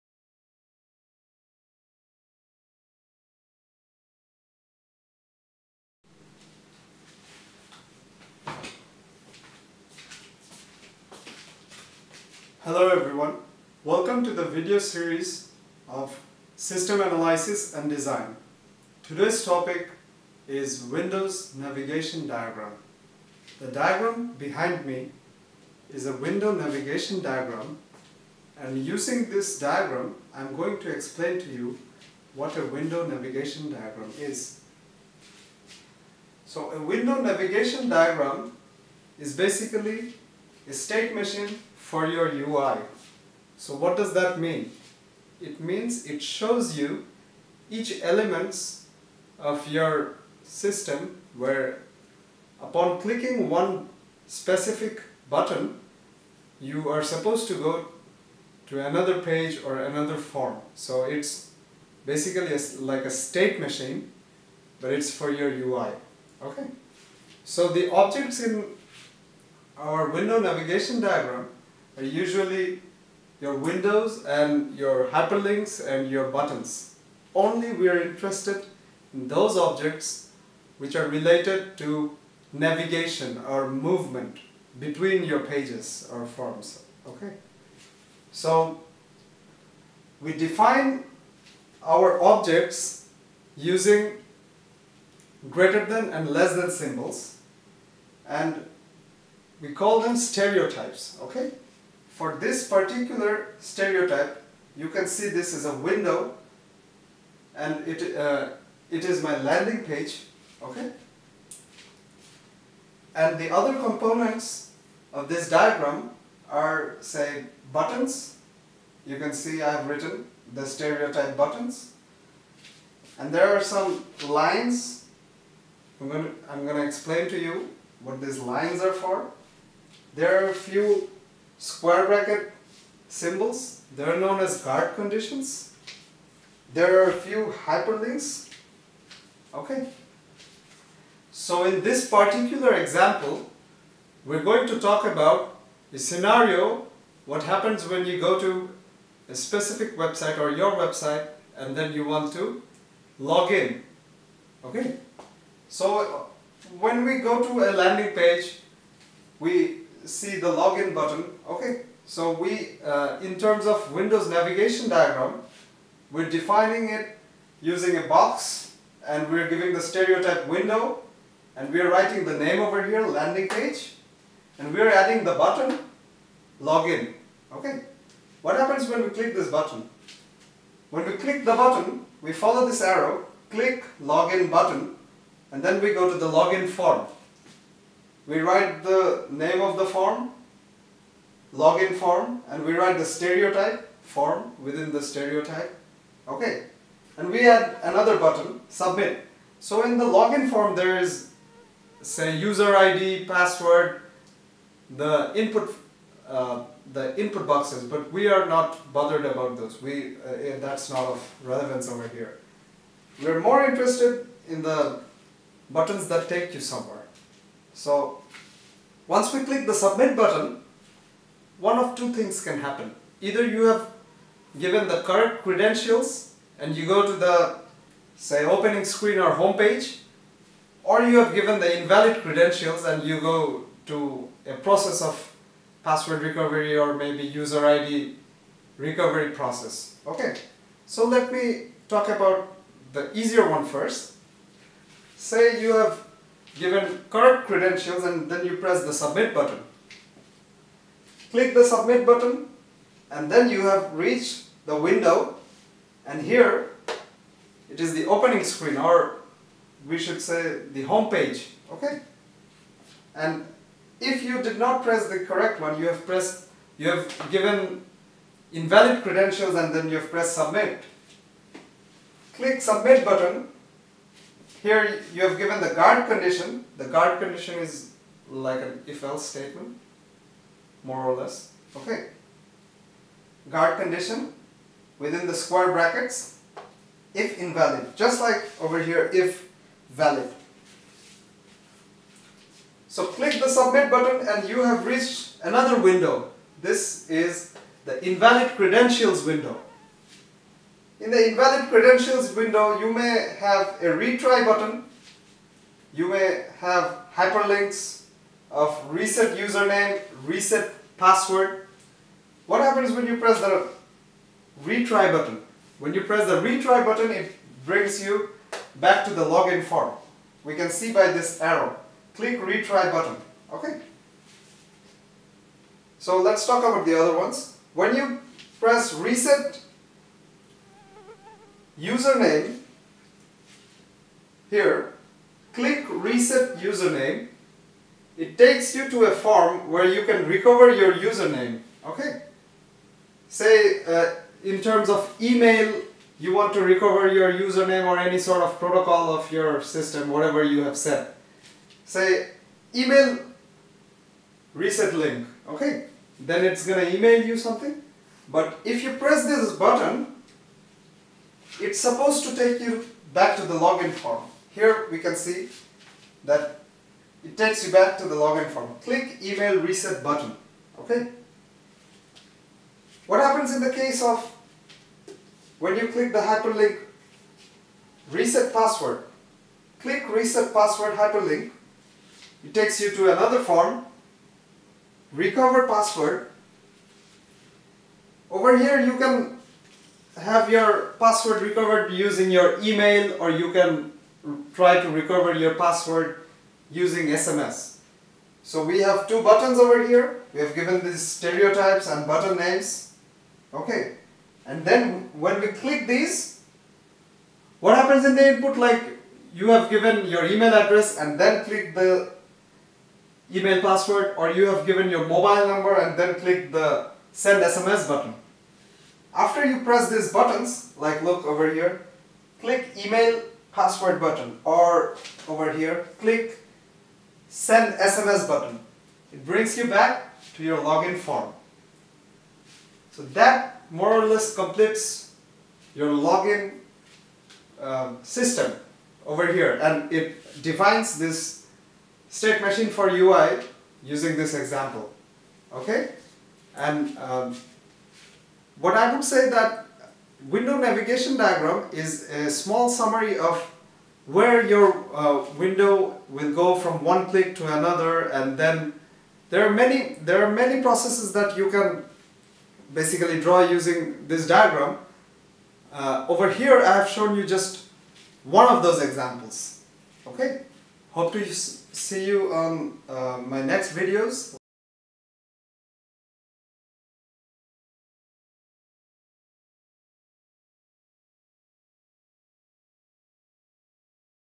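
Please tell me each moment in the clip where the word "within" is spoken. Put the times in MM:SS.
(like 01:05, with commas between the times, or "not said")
03:14, 04:44.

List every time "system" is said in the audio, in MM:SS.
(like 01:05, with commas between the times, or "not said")
00:16, 00:50, 05:49, 07:18.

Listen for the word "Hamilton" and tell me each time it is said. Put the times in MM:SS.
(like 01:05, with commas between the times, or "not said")
not said.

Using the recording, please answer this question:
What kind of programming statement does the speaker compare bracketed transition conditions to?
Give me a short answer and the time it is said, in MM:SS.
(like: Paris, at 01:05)
If-else statement, at 04:38.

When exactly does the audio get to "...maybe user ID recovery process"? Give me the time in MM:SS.
03:56.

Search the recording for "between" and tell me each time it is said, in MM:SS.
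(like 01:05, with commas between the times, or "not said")
01:24.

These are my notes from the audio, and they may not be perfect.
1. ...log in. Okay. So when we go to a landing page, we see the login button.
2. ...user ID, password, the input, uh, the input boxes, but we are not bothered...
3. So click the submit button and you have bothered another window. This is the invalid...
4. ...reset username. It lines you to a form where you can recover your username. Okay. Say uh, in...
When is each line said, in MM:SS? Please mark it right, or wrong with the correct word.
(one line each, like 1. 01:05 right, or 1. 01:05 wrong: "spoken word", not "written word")
1. 02:33 right
2. 03:22 right
3. 04:52 wrong: "reached", not "bothered"
4. 05:35 wrong: "takes", not "lines".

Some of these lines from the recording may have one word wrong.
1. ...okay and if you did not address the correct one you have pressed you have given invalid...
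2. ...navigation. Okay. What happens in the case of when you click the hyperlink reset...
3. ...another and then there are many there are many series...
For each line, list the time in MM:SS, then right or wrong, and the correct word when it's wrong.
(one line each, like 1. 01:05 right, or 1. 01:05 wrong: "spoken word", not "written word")
1. 04:21 wrong: "press", not "address"
2. 06:10 wrong: "button", not "navigation"
3. 07:37 wrong: "processes", not "series".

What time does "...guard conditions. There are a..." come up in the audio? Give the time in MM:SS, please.
02:14.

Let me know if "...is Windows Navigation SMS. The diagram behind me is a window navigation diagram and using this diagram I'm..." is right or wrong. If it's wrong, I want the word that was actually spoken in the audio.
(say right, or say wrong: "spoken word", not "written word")
wrong: "Diagram", not "SMS".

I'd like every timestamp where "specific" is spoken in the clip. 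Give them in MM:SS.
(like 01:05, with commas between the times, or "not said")
00:54, 02:29.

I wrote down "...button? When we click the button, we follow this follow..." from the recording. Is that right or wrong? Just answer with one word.
wrong.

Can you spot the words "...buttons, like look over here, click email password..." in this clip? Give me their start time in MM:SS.
07:00.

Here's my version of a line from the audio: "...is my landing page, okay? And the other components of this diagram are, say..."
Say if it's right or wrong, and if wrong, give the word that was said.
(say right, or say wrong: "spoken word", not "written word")
right.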